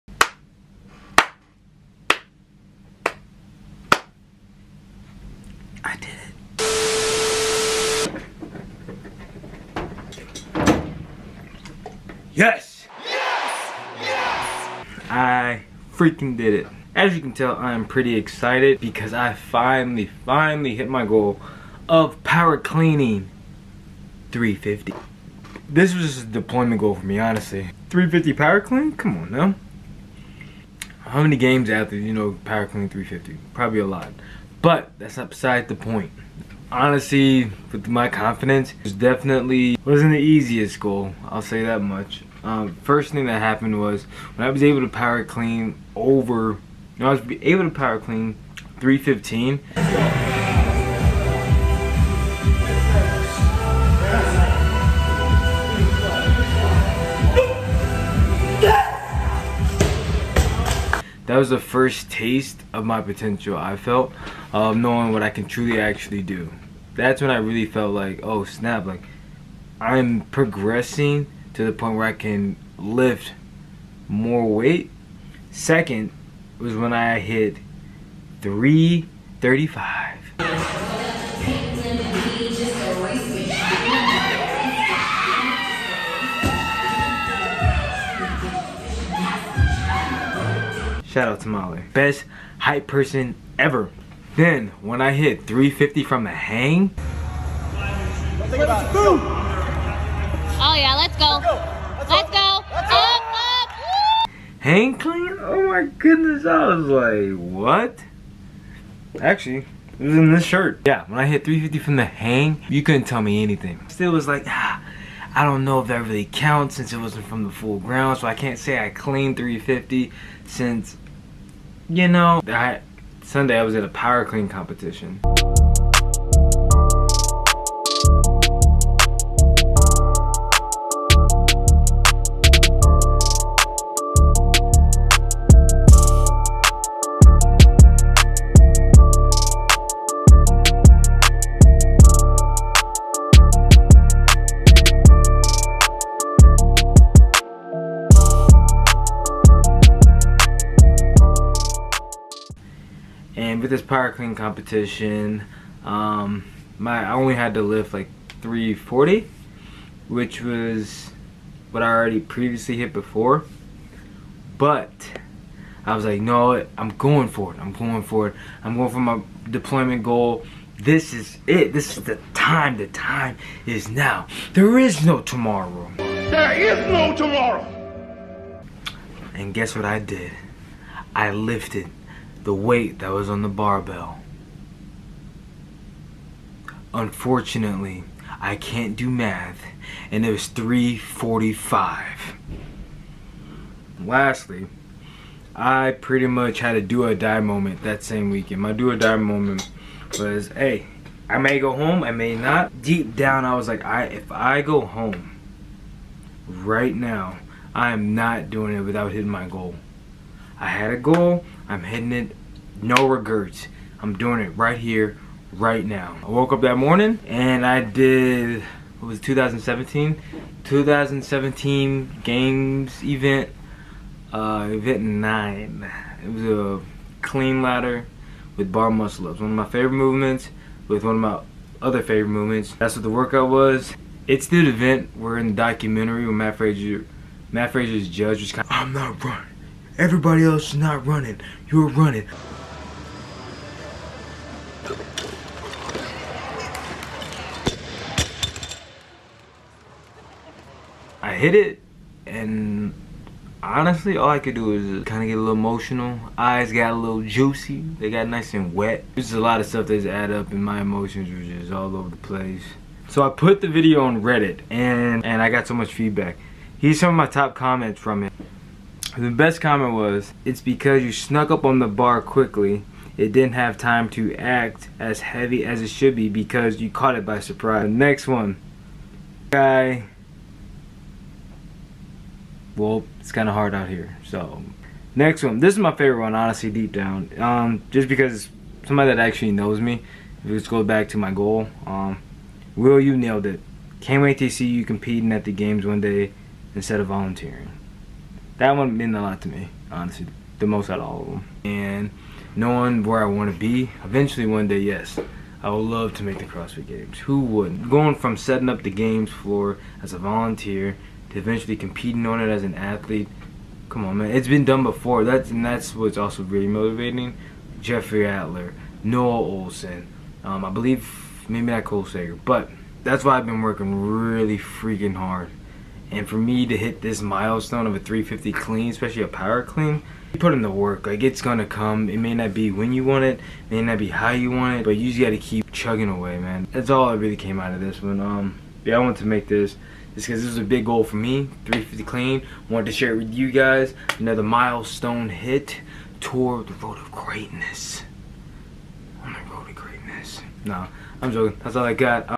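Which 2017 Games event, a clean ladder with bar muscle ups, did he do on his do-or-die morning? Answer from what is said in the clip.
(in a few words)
Event 9.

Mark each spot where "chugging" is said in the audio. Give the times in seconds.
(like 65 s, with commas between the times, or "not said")
335 s.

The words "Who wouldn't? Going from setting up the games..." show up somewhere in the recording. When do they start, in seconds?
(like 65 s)
307 s.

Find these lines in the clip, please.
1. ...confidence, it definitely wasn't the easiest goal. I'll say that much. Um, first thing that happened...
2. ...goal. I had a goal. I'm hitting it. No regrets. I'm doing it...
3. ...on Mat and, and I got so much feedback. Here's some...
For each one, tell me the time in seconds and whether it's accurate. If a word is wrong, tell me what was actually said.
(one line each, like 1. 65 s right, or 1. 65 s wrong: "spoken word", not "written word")
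1. 38 s right
2. 209 s right
3. 264 s wrong: "Reddit", not "Mat".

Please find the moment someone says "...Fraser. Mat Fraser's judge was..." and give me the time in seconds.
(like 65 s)
236 s.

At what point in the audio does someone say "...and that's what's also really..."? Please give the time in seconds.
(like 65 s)
315 s.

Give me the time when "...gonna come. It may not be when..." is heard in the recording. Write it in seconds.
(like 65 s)
331 s.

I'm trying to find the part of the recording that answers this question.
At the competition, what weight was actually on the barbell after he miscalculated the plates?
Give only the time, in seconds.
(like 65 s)
190 s.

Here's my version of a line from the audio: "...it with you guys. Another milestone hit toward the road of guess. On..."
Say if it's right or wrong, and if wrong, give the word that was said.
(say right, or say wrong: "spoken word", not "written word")
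wrong: "greatness", not "guess".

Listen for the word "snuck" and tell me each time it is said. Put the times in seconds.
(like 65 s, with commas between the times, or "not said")
271 s.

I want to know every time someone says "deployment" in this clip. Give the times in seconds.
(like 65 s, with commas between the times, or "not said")
26 s, 169 s.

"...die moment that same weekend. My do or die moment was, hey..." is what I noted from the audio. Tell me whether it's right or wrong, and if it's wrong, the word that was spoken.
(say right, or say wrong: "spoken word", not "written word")
right.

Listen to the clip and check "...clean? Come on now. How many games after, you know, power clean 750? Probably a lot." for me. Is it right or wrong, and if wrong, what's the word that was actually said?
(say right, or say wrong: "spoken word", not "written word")
wrong: "350", not "750".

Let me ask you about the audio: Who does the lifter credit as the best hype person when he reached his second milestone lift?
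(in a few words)
Molly.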